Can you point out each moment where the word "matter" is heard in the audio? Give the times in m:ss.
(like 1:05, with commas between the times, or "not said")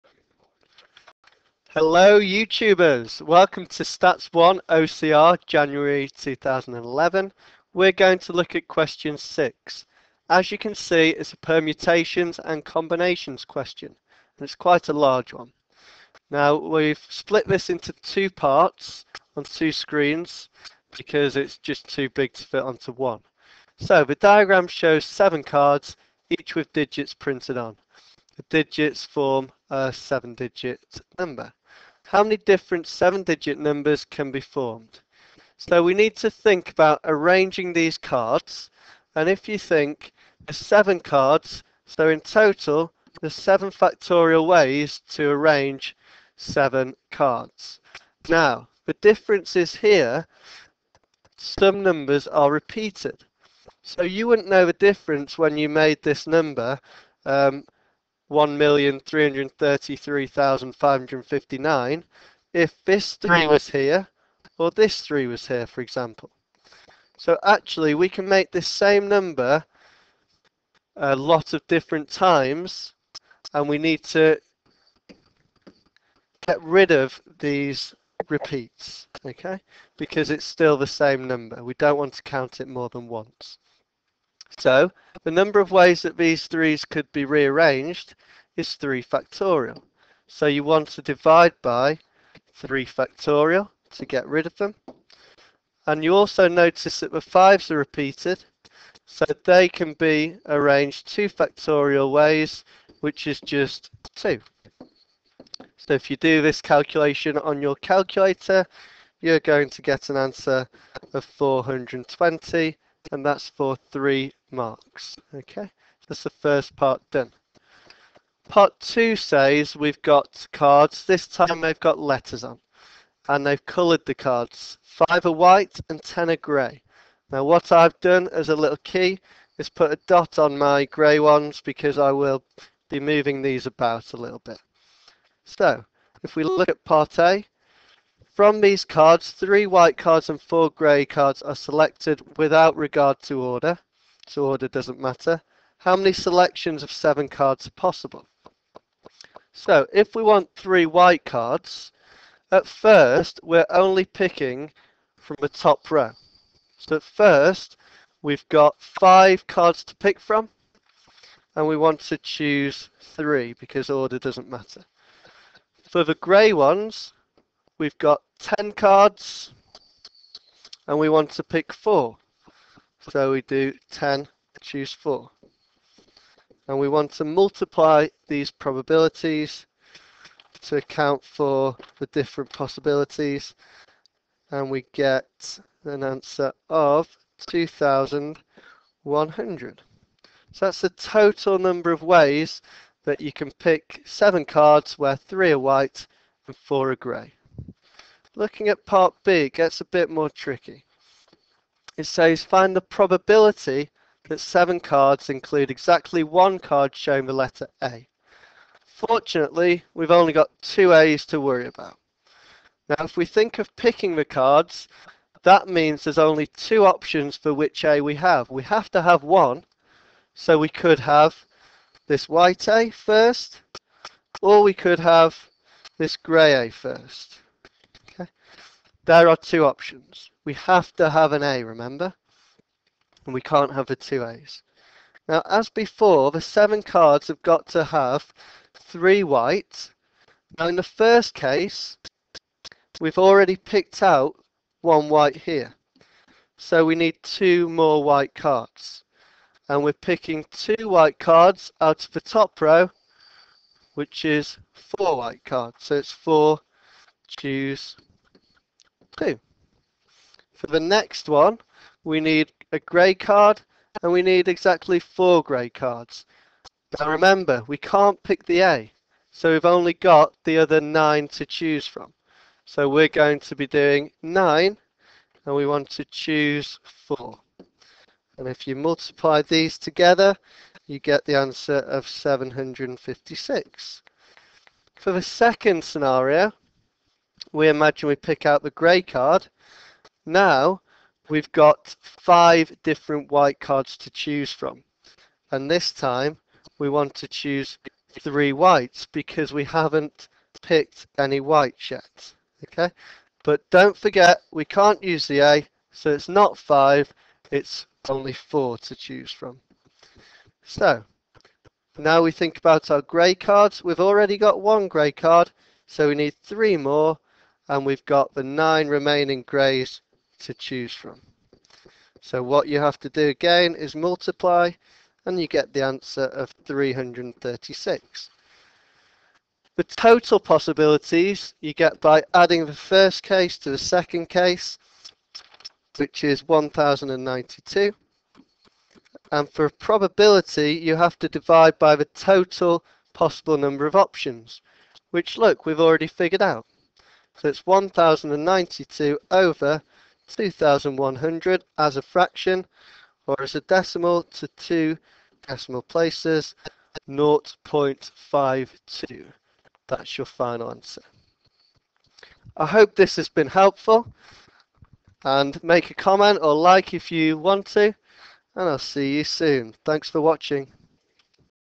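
2:24, 2:44.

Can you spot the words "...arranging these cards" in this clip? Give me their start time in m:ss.
0:37.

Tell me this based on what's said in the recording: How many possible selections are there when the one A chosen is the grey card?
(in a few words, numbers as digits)
336.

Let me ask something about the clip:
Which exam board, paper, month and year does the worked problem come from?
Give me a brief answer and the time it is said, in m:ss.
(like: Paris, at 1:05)
Stats 1 OCR January 2011, at 0:03.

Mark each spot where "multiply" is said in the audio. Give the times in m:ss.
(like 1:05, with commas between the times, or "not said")
2:57, 4:38, 5:23.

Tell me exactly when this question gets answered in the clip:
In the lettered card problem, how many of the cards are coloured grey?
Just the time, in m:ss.
2:06.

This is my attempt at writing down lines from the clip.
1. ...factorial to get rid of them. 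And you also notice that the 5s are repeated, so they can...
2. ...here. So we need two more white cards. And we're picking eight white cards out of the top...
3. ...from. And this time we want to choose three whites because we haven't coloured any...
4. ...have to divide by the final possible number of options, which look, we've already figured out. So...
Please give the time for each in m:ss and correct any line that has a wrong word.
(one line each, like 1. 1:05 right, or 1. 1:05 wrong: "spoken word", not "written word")
1. 1:32 right
2. 4:05 wrong: "two", not "eight"
3. 4:54 wrong: "picked", not "coloured"
4. 5:40 wrong: "total", not "final".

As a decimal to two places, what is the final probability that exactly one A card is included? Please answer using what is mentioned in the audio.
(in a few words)
0.52.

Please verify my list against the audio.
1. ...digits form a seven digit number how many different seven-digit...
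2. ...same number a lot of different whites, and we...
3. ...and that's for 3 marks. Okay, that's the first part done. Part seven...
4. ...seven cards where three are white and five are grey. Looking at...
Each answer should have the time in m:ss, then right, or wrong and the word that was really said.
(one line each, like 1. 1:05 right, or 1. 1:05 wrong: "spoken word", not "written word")
1. 0:28 right
2. 1:08 wrong: "times", not "whites"
3. 1:53 wrong: "two", not "seven"
4. 3:14 wrong: "four", not "five".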